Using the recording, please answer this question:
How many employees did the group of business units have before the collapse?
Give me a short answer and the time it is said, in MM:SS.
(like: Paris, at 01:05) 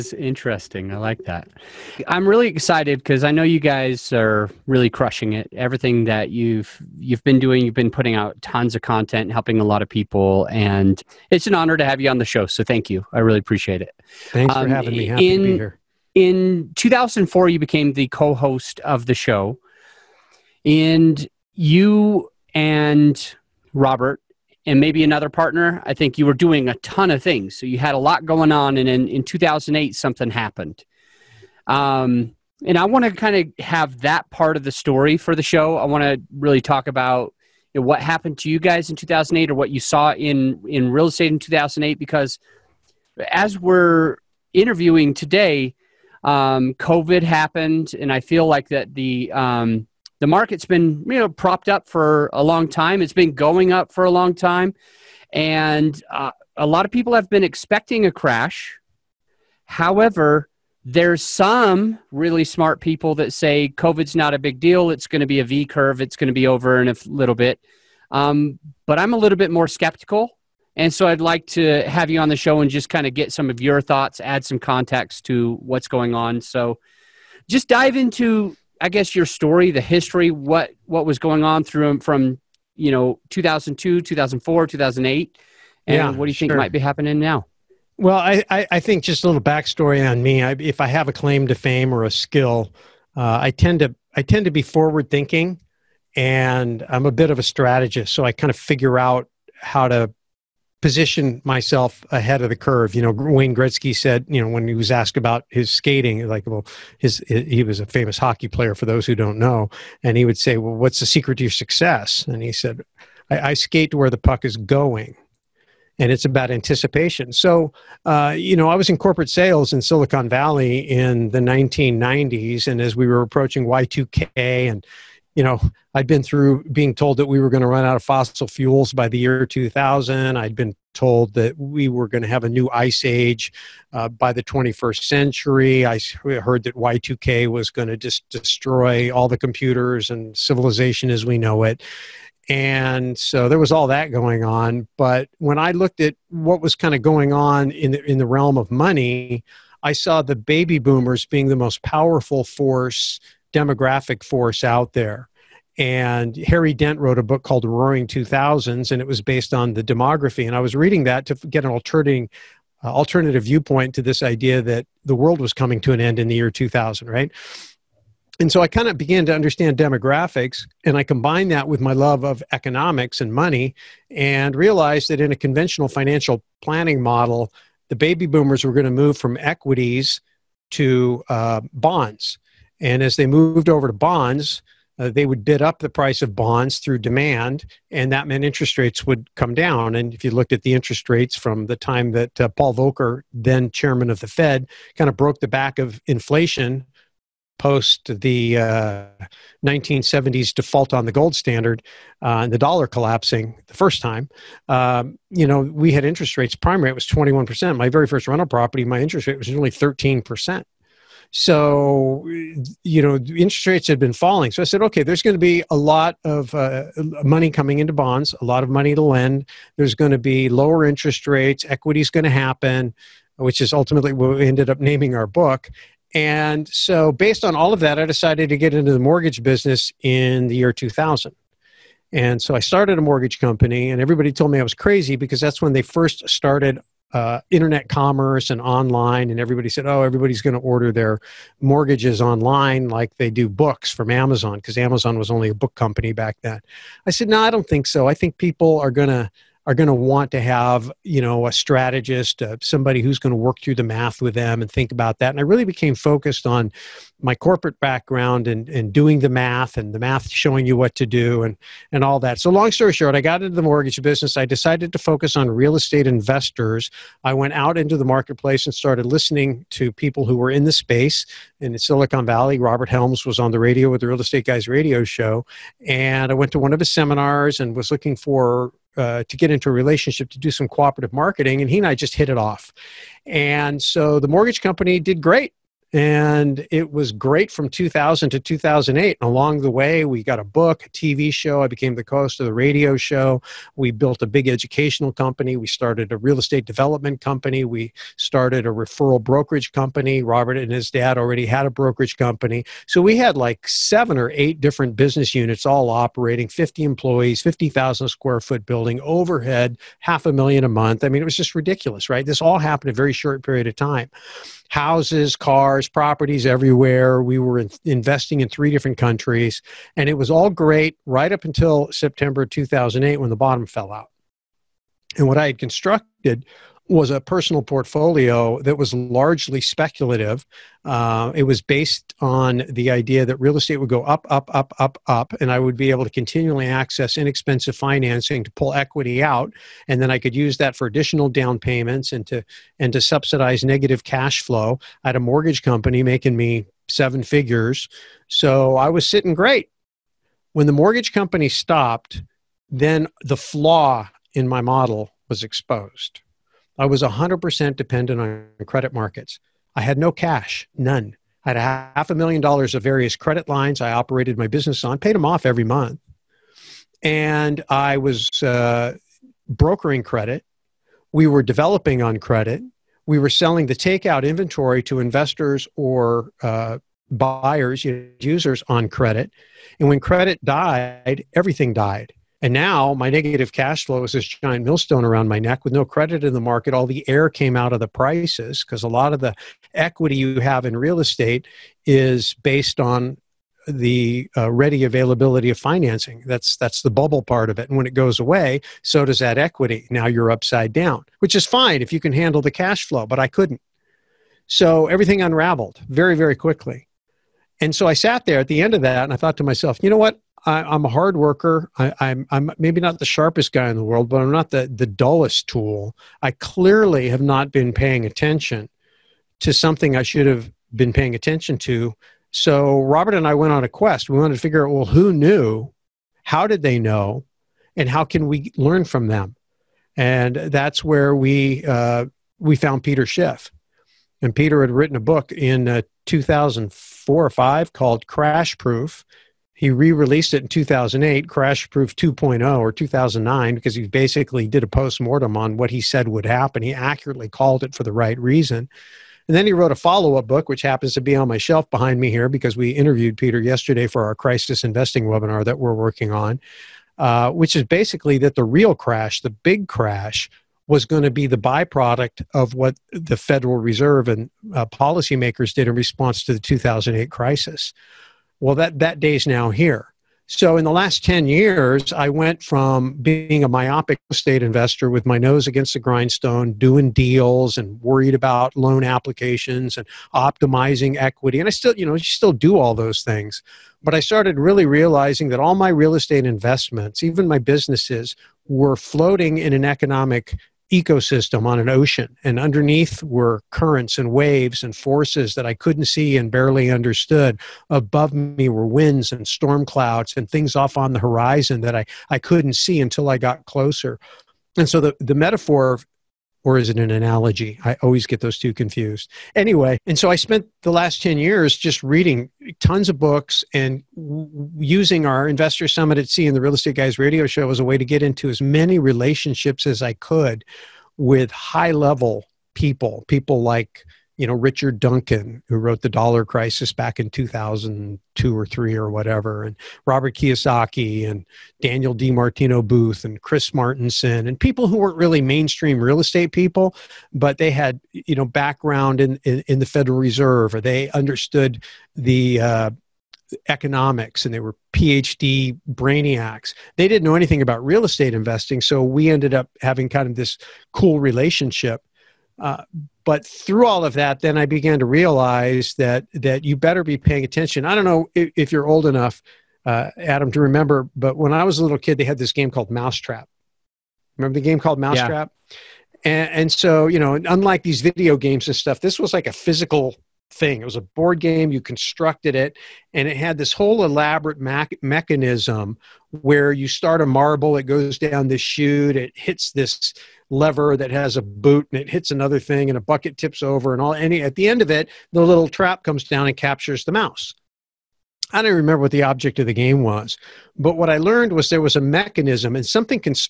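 50, at 05:06.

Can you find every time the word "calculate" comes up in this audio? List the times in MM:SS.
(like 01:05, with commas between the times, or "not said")
not said.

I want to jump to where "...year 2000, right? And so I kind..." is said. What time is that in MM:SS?
02:46.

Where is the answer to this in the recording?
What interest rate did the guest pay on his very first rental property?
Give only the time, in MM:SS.
03:29.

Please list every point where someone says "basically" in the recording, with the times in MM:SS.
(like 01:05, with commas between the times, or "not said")
07:23, 07:37.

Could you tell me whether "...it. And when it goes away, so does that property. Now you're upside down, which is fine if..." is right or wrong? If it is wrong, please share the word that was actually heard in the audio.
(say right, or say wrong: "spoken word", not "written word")
wrong: "equity", not "property".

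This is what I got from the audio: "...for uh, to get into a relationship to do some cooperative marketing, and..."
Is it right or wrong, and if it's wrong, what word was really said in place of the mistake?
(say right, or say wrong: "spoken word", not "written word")
right.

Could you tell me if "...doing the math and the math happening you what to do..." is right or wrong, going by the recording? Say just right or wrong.
wrong.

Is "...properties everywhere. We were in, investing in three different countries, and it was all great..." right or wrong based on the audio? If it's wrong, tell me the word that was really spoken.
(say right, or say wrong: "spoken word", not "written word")
right.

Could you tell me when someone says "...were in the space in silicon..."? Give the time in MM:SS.
04:30.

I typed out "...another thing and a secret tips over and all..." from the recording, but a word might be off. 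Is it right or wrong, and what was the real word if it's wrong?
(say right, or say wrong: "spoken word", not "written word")
wrong: "bucket", not "secret".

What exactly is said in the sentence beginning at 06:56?
I clearly have not been paying attention to something I should have been paying attention to.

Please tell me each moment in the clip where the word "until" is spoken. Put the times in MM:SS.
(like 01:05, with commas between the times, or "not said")
05:21, 08:22.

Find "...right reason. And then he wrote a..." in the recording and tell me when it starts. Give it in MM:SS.
07:27.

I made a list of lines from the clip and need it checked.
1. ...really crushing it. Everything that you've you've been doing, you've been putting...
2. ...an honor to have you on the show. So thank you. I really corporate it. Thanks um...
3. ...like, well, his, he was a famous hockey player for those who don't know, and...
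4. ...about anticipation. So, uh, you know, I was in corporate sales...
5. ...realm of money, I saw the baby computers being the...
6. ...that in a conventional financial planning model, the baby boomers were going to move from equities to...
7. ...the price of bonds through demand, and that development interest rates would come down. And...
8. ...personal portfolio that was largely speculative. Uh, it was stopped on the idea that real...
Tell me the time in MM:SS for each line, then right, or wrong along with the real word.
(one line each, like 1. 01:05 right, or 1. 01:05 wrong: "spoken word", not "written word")
1. 00:04 right
2. 00:11 wrong: "appreciate", not "corporate"
3. 01:46 right
4. 01:56 right
5. 02:28 wrong: "boomers", not "computers"
6. 02:55 right
7. 03:05 wrong: "meant", not "development"
8. 05:27 wrong: "based", not "stopped".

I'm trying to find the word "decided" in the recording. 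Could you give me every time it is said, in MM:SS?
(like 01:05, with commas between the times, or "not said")
03:48, 04:24.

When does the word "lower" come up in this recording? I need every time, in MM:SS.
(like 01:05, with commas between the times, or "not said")
03:40.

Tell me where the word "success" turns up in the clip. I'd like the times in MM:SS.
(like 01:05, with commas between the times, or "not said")
01:51.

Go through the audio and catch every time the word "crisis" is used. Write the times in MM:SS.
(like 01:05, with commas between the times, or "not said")
07:34, 07:47, 08:46.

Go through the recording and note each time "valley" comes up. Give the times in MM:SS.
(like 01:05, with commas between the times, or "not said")
02:00, 04:32.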